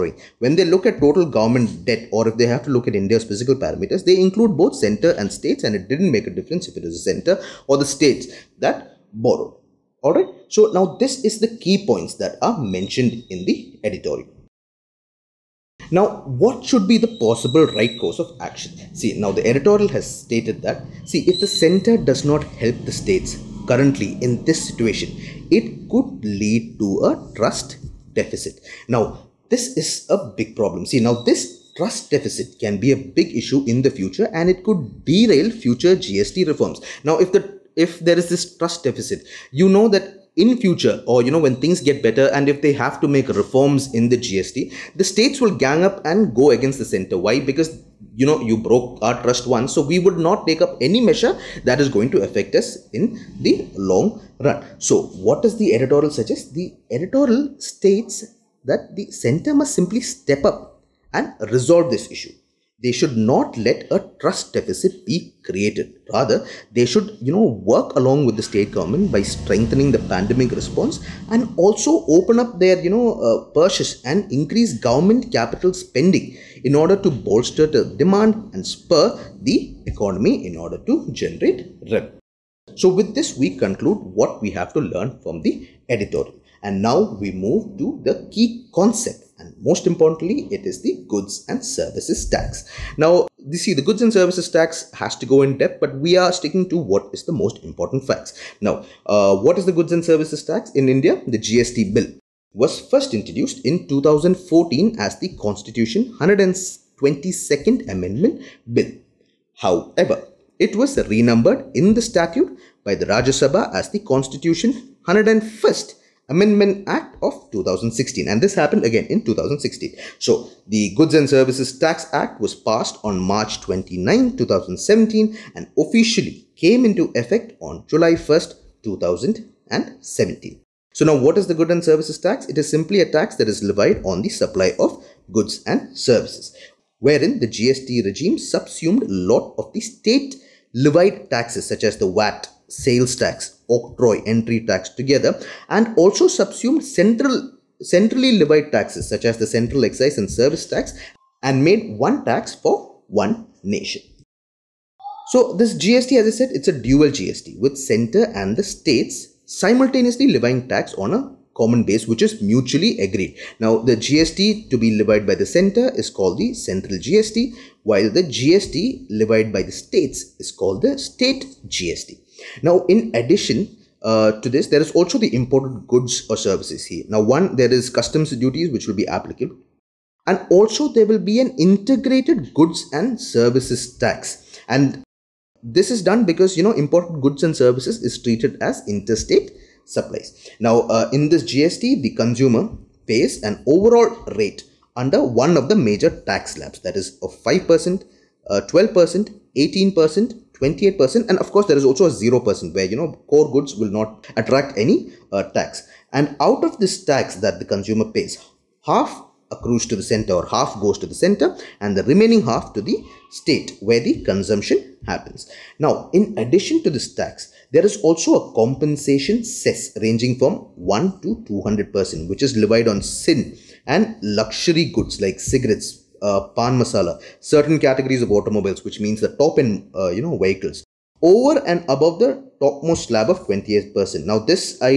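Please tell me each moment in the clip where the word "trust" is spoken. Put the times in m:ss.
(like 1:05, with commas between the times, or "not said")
0:27, 0:31, 0:38, 0:49, 1:04.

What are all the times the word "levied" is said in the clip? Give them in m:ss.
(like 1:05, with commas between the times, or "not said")
2:13, 2:20, 2:28, 2:45, 2:49, 3:42.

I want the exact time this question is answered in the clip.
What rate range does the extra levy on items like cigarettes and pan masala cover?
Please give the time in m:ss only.
3:40.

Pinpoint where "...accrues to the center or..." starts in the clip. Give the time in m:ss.
3:29.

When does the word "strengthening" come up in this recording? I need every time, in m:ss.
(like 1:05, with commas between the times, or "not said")
1:09.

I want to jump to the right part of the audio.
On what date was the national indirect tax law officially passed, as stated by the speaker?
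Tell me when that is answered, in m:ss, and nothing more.
2:03.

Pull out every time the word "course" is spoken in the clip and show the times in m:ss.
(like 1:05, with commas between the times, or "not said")
0:18, 3:21.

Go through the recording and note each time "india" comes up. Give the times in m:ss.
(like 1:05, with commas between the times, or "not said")
0:02, 1:40.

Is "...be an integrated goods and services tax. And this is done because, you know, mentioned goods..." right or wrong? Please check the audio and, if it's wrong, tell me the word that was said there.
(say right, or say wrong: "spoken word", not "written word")
wrong: "imported", not "mentioned".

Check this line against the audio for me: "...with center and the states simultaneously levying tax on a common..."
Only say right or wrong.
right.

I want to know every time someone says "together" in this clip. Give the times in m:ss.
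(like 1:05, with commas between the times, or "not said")
2:24.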